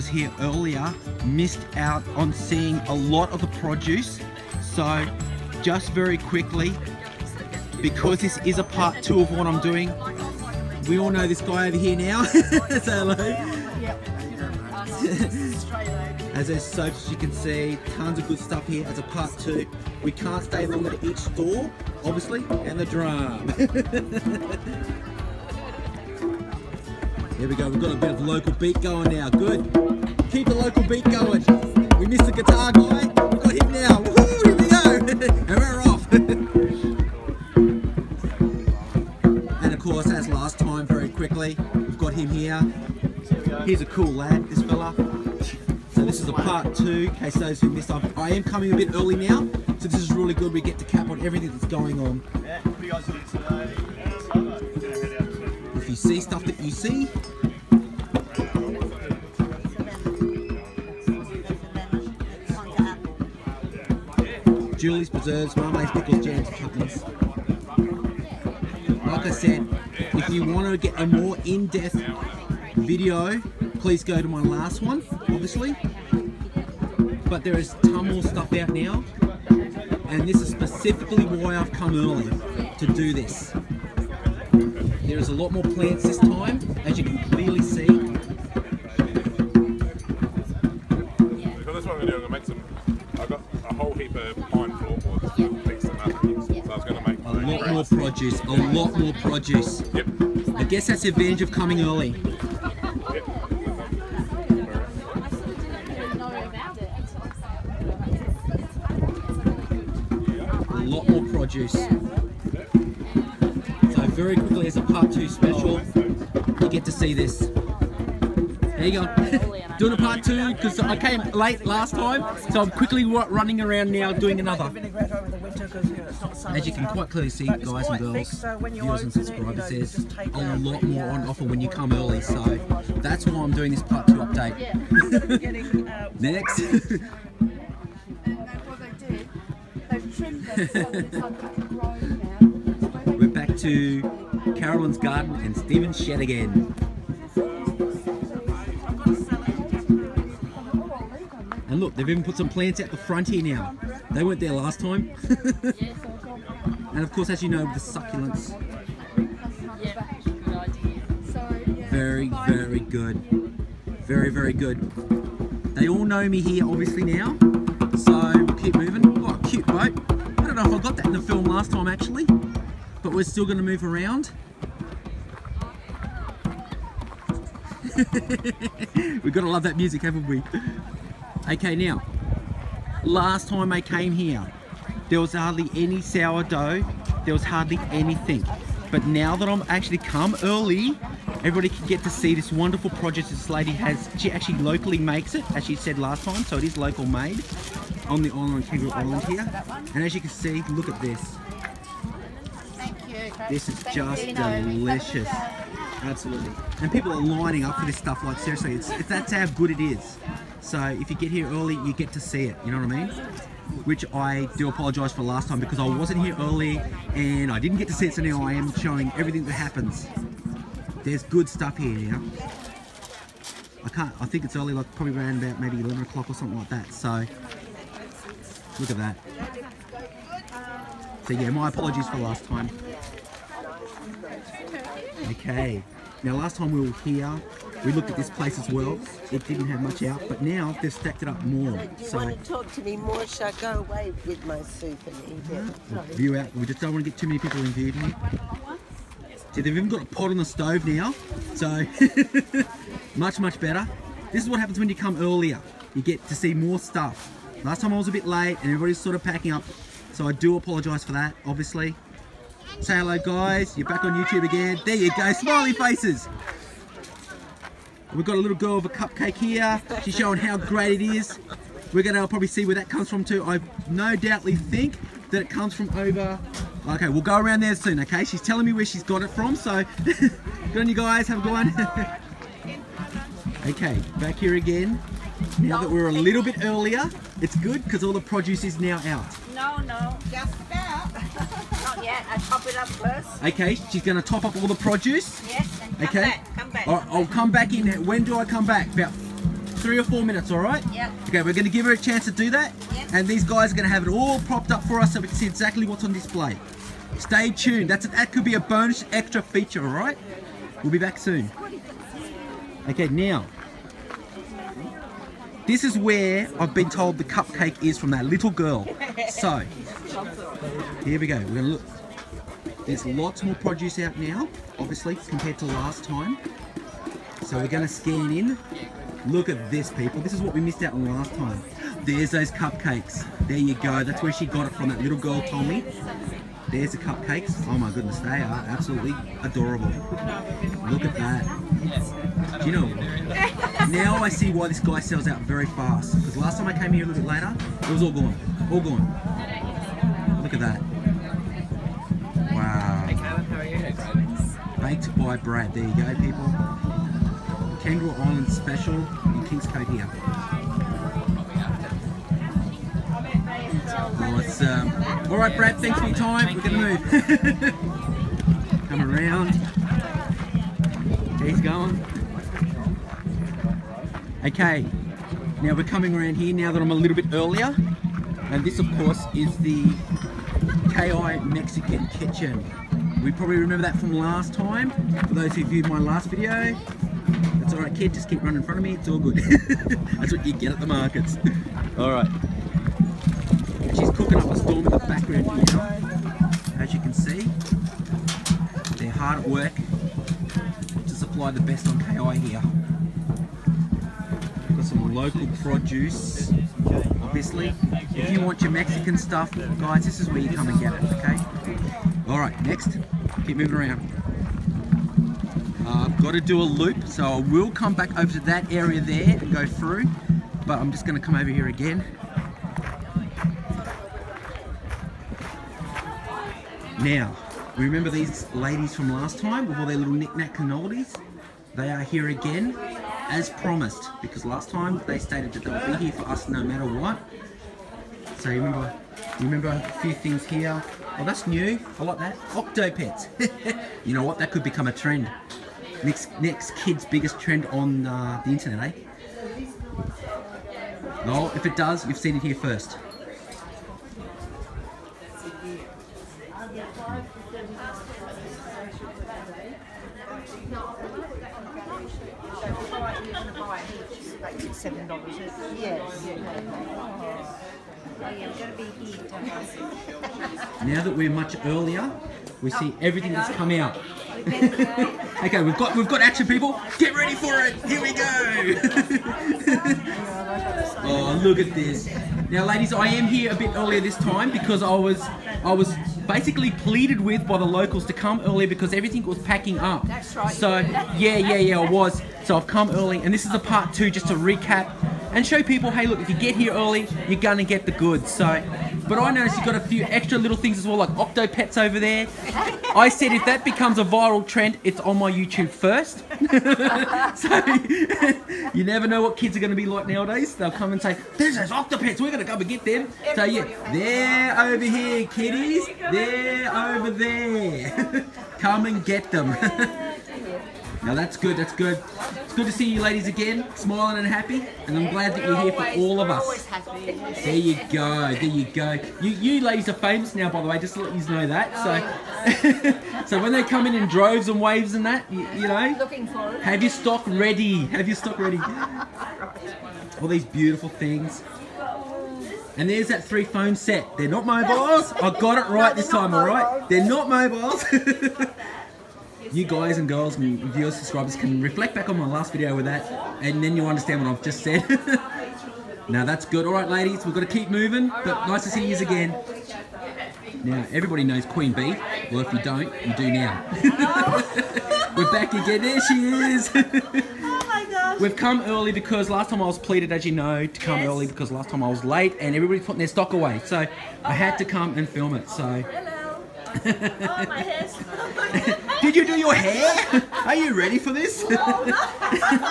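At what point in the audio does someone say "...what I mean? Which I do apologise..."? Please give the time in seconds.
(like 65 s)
212 s.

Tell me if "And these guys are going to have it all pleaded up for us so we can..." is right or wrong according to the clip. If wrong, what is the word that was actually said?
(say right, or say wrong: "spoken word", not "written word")
wrong: "propped", not "pleaded".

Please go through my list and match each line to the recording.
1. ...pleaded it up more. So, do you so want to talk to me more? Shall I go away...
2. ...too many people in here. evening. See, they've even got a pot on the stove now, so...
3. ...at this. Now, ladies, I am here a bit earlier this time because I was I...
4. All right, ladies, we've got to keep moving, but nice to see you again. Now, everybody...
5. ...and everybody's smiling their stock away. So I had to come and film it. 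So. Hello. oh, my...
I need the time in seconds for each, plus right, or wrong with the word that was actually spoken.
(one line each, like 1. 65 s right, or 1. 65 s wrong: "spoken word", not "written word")
1. 240 s wrong: "stacked", not "pleaded"
2. 247 s right
3. 481 s right
4. 556 s right
5. 572 s wrong: "putting", not "smiling".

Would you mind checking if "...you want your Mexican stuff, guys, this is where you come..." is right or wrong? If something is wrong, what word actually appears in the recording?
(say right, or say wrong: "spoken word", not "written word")
right.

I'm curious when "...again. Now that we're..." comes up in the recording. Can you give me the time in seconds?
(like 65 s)
284 s.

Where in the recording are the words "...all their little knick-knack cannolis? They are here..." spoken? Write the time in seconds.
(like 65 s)
429 s.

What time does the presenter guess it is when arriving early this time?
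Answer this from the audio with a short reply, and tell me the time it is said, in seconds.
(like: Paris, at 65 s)
11 o'clock, at 225 s.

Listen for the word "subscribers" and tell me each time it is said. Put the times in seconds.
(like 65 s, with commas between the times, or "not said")
129 s, 550 s.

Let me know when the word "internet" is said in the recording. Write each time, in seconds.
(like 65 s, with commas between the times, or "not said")
448 s.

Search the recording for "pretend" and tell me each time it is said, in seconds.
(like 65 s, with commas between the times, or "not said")
not said.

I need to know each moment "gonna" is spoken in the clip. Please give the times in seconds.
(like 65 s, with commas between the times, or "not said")
272 s, 421 s, 497 s.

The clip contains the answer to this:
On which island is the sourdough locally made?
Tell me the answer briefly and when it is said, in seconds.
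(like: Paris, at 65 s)
Kangaroo Island, at 198 s.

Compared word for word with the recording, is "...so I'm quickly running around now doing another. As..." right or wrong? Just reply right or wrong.
right.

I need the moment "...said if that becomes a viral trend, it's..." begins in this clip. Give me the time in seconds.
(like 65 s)
503 s.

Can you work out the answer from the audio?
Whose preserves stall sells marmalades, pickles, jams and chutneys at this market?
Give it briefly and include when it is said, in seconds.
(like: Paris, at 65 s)
Julie's, at 64 s.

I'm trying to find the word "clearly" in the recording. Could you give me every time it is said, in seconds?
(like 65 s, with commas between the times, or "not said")
87 s, 127 s.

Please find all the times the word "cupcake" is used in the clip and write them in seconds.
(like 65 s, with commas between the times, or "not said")
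268 s, 317 s, 332 s, 336 s.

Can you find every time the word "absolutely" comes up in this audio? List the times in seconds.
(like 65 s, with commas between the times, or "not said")
206 s, 338 s.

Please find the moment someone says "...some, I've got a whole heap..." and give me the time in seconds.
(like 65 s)
92 s.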